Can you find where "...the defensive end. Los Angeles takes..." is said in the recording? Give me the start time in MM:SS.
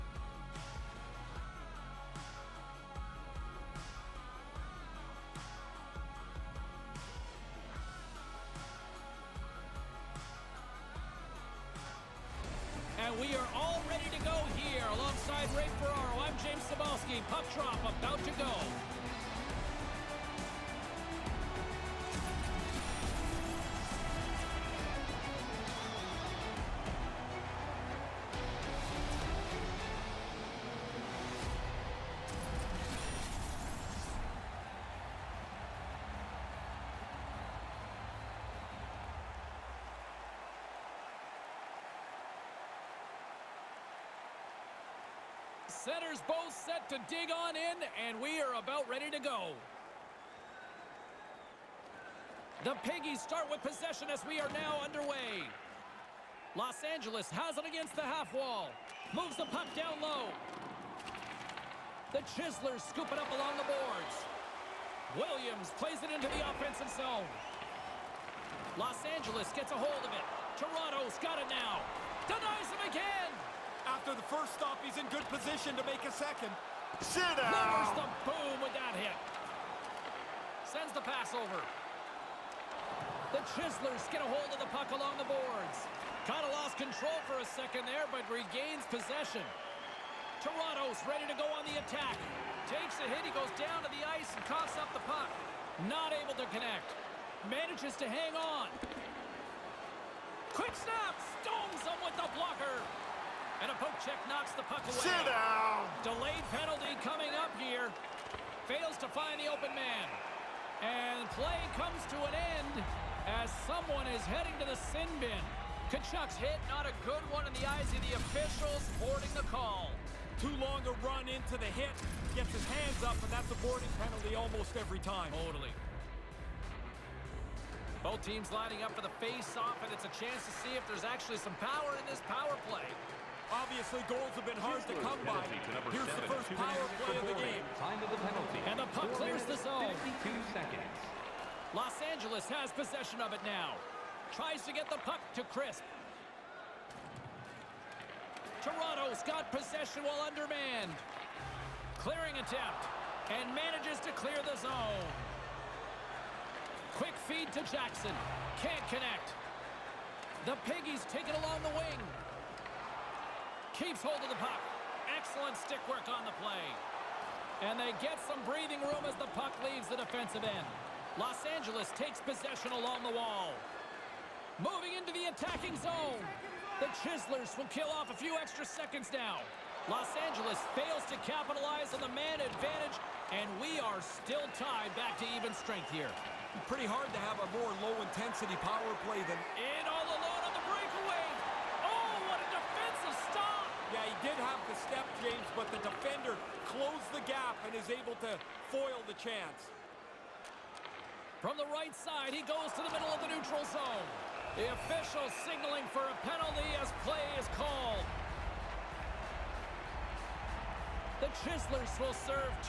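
02:49.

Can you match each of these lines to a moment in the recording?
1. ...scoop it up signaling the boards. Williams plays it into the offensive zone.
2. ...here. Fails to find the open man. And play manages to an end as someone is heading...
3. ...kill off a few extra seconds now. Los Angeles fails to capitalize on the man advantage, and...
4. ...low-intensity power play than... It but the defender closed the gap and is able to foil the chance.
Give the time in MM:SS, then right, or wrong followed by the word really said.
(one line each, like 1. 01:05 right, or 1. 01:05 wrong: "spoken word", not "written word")
1. 01:02 wrong: "along", not "signaling"
2. 01:47 wrong: "comes", not "manages"
3. 02:57 right
4. 03:07 right.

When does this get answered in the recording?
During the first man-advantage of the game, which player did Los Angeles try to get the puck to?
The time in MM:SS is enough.
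02:25.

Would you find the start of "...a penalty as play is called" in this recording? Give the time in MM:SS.
03:26.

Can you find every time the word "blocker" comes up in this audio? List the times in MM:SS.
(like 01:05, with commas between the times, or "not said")
01:42.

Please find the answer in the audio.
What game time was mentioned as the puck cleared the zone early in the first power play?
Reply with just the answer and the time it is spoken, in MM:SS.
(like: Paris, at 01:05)
52 seconds, at 02:20.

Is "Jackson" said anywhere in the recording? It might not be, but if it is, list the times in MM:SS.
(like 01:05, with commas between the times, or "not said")
02:37.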